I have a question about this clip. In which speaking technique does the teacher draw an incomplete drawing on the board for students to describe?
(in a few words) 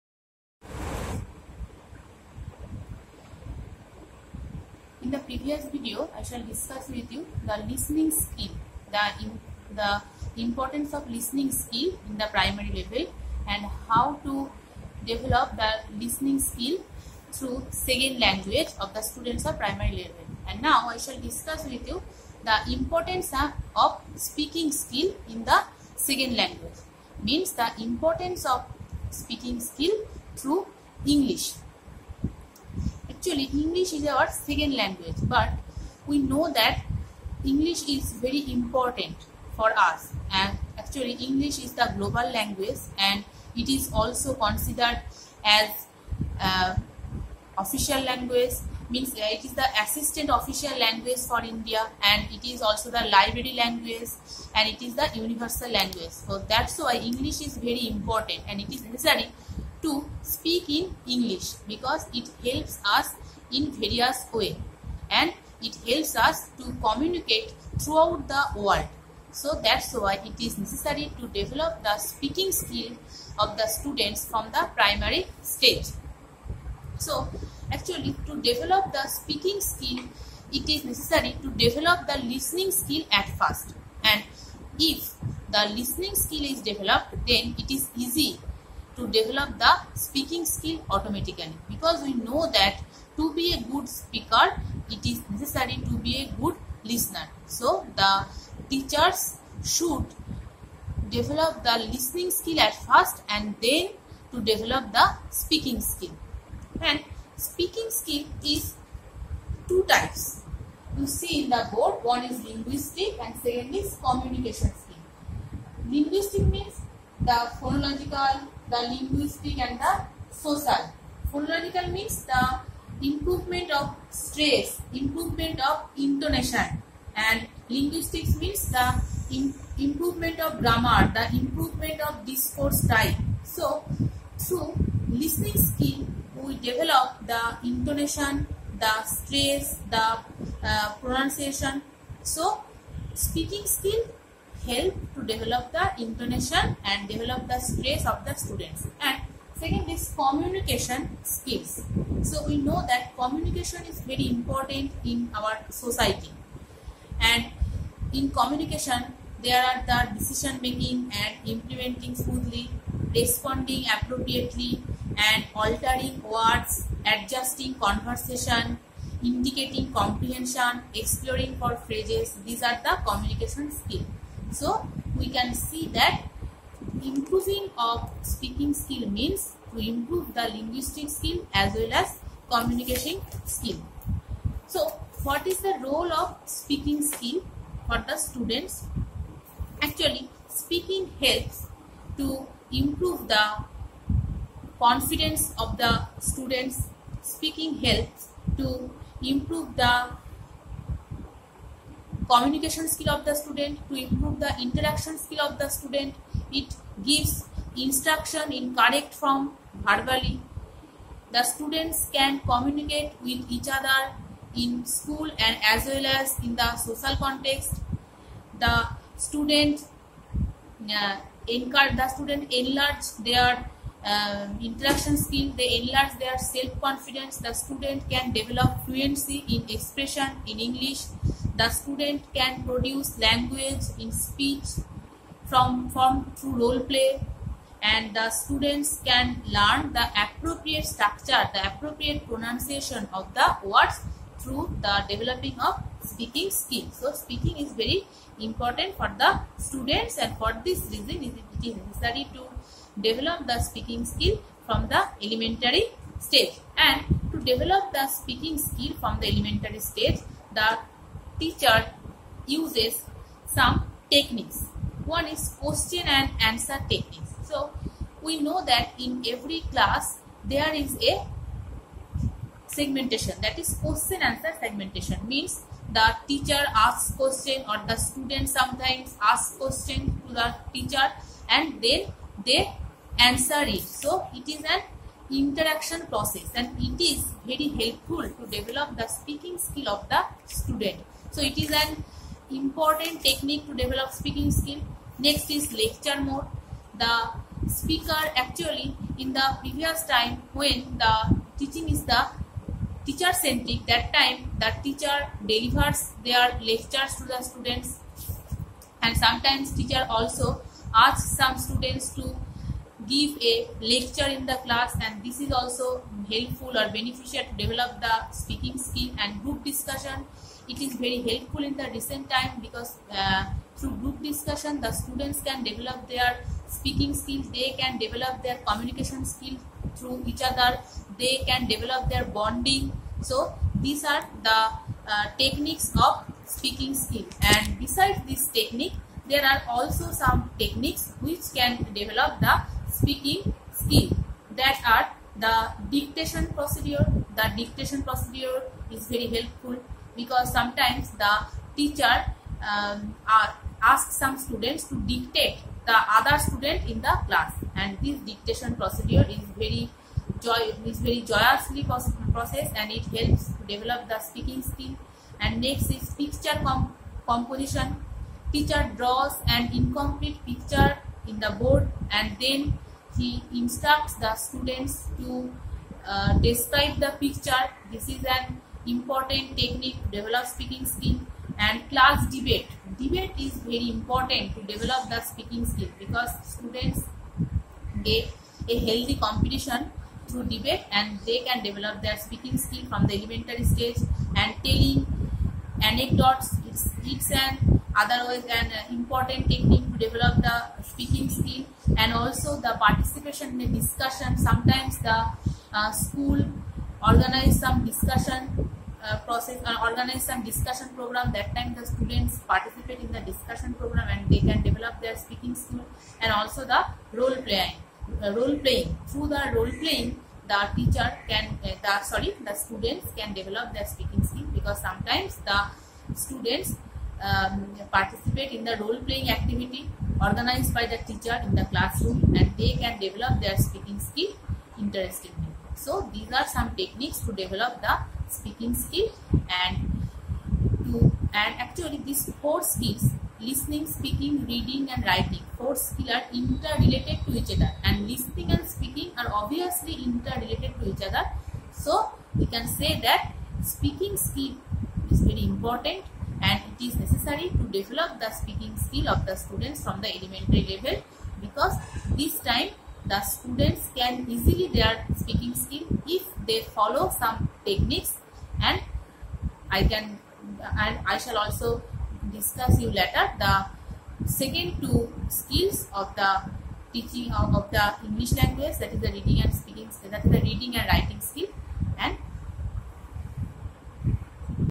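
picture composition.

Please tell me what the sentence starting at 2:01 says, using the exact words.
Phonological means the improvement of stress, improvement of intonation and linguistics means the improvement of grammar, the improvement of discourse type.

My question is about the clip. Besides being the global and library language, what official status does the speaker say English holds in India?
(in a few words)
assistant official language.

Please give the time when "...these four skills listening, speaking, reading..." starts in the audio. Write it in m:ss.
7:22.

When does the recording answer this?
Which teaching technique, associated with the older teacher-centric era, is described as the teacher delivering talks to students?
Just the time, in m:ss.
4:55.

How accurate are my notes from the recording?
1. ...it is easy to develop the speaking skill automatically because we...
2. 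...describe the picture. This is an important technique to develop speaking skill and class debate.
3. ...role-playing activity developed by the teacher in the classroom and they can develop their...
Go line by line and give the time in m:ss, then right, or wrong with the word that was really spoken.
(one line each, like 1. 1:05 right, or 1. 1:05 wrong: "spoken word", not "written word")
1. 1:27 right
2. 6:16 right
3. 7:08 wrong: "organized", not "developed".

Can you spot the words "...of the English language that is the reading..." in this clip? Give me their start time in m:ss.
7:57.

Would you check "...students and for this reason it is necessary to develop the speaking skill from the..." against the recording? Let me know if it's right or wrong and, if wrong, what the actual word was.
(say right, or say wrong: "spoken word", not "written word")
right.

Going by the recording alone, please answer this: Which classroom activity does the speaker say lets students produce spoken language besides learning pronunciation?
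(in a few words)
role play.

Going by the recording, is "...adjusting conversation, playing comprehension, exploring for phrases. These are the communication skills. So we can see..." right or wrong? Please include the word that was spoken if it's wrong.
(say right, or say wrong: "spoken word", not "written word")
wrong: "indicating", not "playing".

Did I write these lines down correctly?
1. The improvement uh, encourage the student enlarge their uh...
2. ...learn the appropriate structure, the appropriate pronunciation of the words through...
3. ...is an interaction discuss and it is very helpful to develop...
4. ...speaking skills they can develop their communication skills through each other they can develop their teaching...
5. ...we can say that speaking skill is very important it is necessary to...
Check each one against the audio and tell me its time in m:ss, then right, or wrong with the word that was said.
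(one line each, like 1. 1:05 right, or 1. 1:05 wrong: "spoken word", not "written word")
1. 3:38 wrong: "student", not "improvement"
2. 3:59 right
3. 4:44 wrong: "process", not "discuss"
4. 5:26 wrong: "bonding", not "teaching"
5. 7:32 right.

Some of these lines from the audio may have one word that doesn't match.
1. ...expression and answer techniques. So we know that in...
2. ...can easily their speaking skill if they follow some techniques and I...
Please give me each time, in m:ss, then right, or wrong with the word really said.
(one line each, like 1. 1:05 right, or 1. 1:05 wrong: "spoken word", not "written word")
1. 4:25 wrong: "question", not "expression"
2. 7:43 right.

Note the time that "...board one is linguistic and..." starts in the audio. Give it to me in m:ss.
1:51.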